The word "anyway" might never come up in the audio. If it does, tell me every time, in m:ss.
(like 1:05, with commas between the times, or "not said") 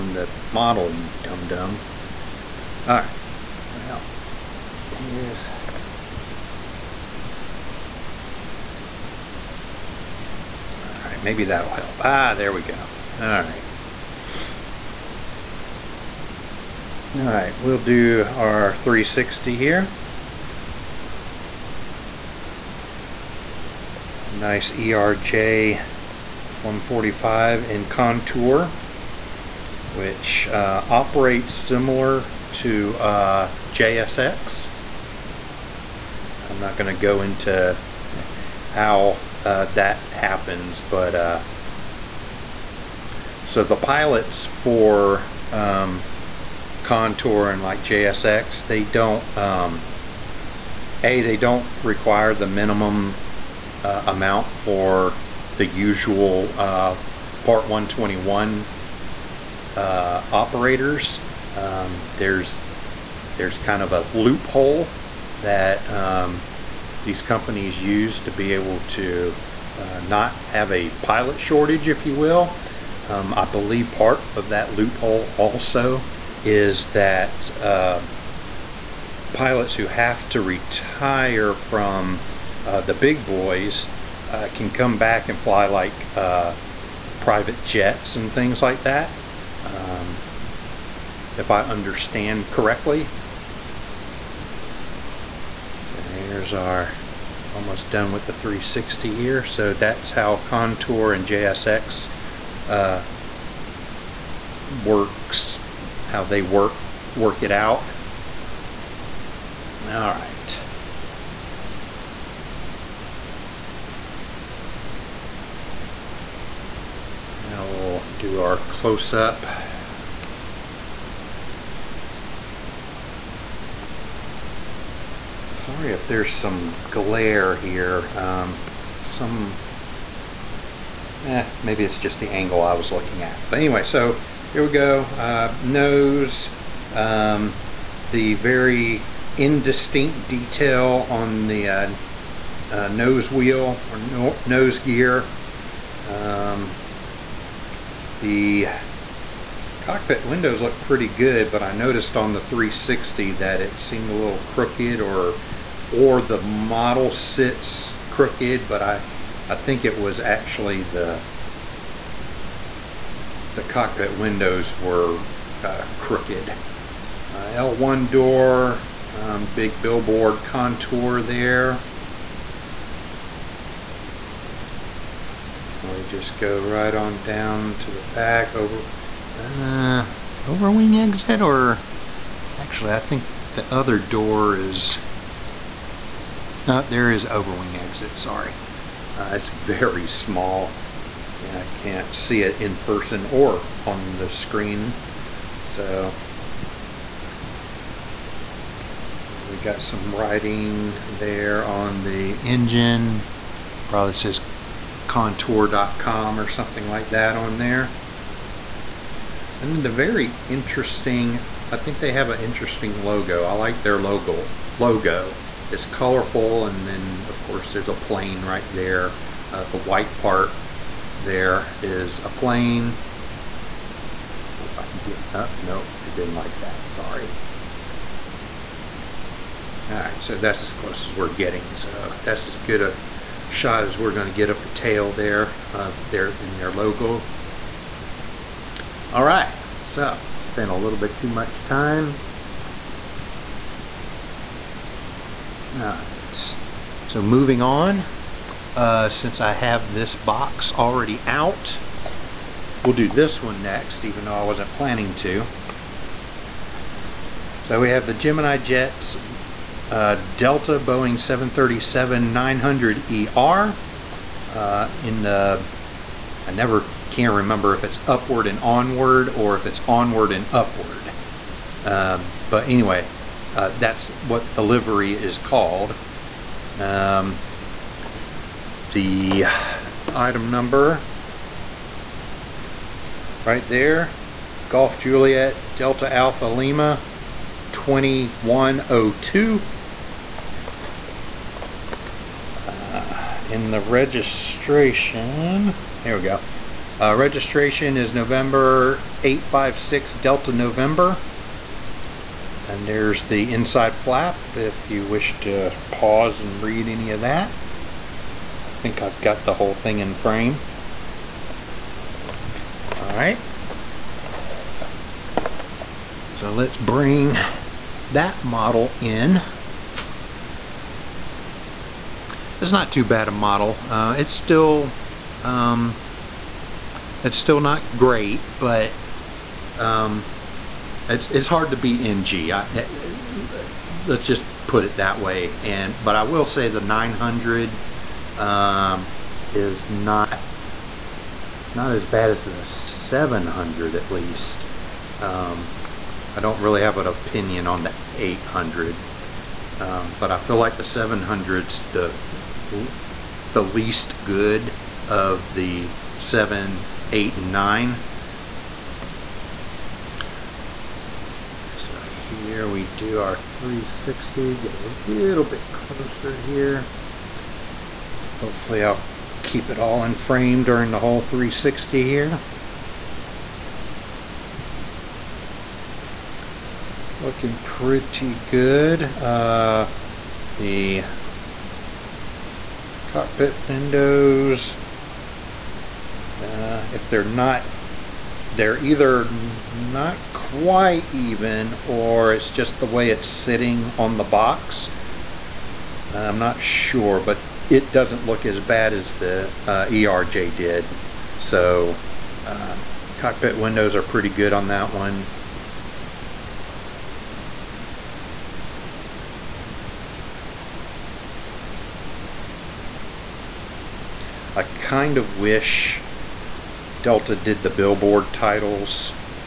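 2:13, 4:32.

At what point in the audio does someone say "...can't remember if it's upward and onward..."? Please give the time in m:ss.
4:27.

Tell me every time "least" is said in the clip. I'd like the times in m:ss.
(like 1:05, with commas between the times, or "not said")
5:44, 5:53.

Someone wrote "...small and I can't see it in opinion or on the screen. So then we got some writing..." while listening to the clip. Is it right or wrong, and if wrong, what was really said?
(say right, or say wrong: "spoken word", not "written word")
wrong: "person", not "opinion".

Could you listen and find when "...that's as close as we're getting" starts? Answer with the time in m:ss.
3:50.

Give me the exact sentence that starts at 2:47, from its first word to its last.
Uh, L1 door, um, big billboard contour there.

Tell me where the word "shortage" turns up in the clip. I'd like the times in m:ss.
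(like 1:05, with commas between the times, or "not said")
1:11.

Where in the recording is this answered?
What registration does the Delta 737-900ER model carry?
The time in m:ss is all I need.
4:58.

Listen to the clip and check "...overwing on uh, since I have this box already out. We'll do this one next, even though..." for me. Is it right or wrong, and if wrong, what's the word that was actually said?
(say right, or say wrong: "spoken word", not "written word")
wrong: "moving", not "overwing".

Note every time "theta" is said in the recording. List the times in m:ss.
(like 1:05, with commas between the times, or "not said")
not said.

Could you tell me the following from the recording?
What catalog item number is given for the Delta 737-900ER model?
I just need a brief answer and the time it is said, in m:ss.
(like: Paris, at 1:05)
GJDAL2102, at 4:44.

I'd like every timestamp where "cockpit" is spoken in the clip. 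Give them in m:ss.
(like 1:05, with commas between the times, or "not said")
2:29, 2:43, 6:23, 6:43.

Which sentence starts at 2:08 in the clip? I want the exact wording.
Um, some, eh, maybe it's just the angle I was looking at.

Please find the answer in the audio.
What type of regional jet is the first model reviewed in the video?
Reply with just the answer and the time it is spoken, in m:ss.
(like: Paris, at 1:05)
ERJ 145, at 0:24.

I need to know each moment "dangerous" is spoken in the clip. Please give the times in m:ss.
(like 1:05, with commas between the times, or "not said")
not said.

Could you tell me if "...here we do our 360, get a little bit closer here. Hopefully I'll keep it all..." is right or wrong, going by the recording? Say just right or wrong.
right.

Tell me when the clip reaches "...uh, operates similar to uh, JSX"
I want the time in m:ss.
0:30.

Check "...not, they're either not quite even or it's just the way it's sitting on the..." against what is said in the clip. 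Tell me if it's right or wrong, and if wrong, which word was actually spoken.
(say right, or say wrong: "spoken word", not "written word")
right.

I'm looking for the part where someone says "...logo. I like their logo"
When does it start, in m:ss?
3:33.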